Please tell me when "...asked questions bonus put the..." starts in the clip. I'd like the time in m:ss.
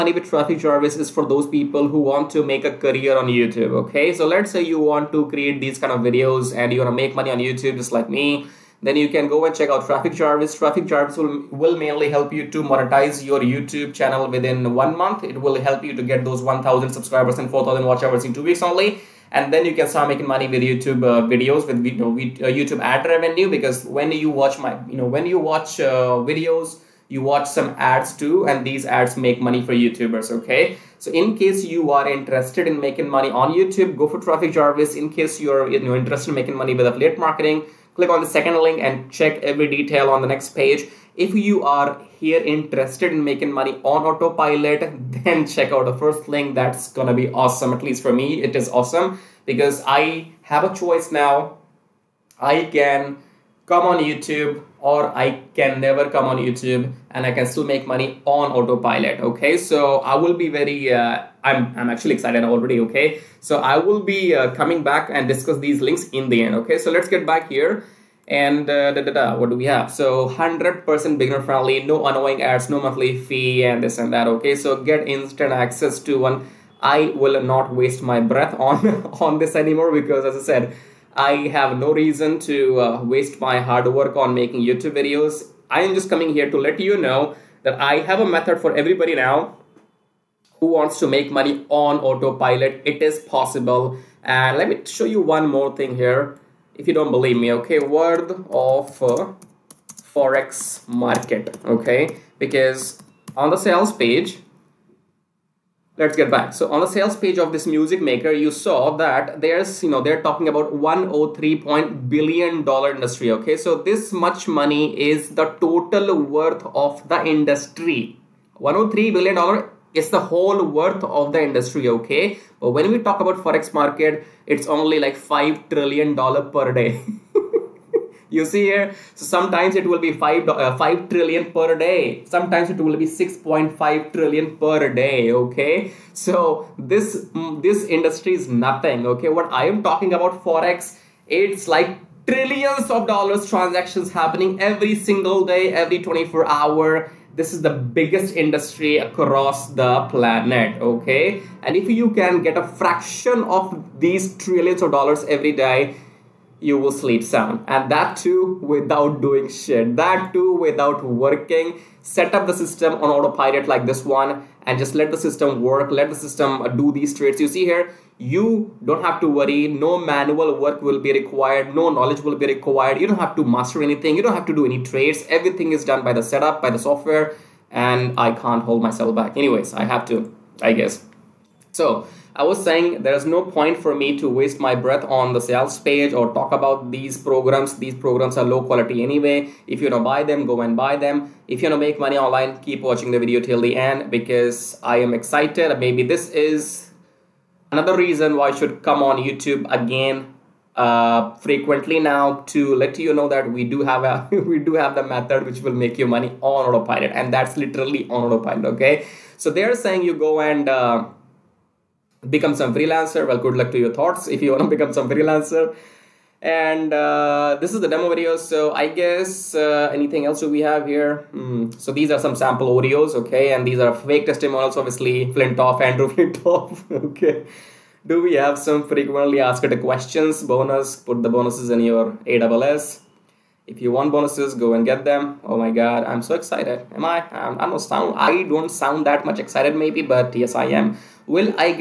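3:49.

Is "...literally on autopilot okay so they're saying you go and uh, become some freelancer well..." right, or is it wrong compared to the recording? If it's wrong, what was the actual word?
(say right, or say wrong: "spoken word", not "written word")
right.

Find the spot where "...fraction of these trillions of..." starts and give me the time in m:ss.
2:32.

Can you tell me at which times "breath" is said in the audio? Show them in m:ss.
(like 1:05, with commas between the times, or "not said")
1:18, 3:04.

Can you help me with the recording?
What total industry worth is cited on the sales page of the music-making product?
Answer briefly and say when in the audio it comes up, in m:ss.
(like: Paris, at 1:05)
$103 billion, at 1:58.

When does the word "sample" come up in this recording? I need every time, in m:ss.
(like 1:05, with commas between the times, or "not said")
3:42.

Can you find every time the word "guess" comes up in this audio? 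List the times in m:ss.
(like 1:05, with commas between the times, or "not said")
3:00, 3:38.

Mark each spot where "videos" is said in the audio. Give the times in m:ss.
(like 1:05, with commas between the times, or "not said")
0:06, 0:21, 0:26, 1:24, 3:13, 3:38.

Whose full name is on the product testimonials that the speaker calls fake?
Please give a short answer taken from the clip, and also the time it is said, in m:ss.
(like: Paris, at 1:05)
Andrew Flintoff, at 3:45.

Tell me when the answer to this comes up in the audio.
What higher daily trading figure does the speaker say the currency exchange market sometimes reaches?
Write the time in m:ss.
2:13.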